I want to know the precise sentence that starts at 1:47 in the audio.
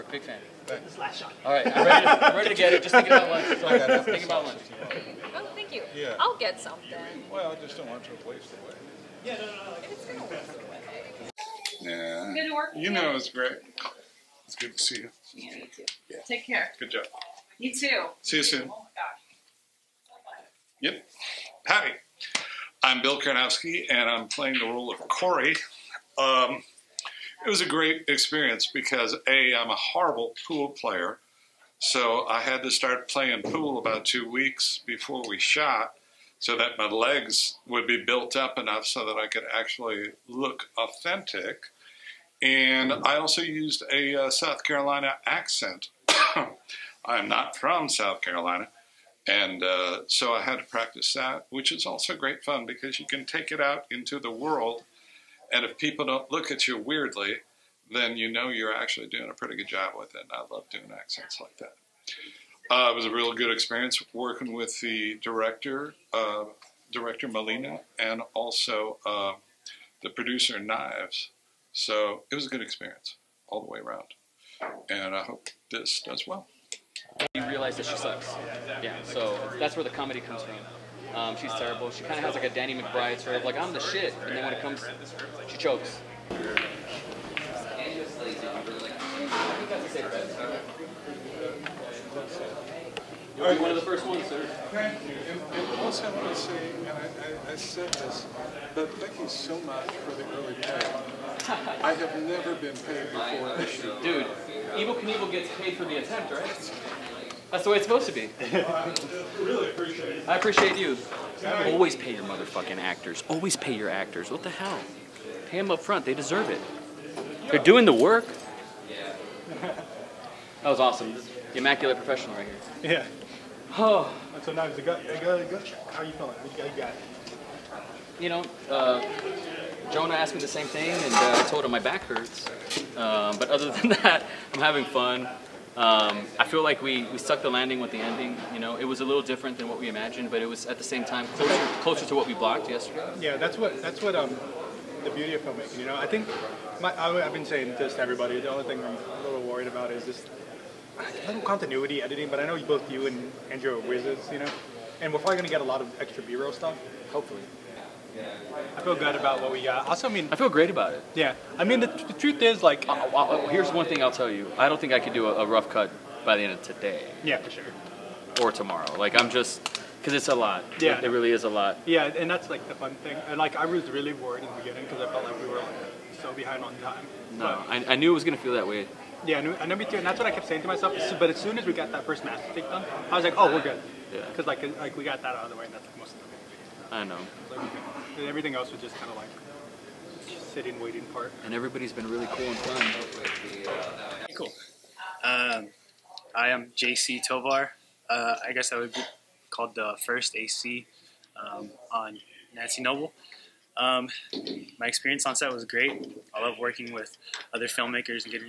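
That's the way it's supposed to be.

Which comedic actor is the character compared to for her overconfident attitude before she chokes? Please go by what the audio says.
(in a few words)
Danny McBride.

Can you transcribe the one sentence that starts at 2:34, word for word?
You know, and we're probably going to get a lot of extra B-roll stuff.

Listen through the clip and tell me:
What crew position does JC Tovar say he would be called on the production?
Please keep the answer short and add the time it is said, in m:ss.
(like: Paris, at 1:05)
first AC, at 3:20.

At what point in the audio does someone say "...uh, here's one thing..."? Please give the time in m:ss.
2:43.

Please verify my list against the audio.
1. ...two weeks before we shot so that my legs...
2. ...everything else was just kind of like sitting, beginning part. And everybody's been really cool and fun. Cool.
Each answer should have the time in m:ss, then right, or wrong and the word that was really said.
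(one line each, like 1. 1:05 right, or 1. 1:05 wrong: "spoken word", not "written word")
1. 0:34 right
2. 3:08 wrong: "waiting", not "beginning".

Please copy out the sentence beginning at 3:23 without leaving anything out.
Um, my experience on set was great.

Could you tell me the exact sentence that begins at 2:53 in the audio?
And like, I was really worried in the beginning because I felt like we were like so behind on time.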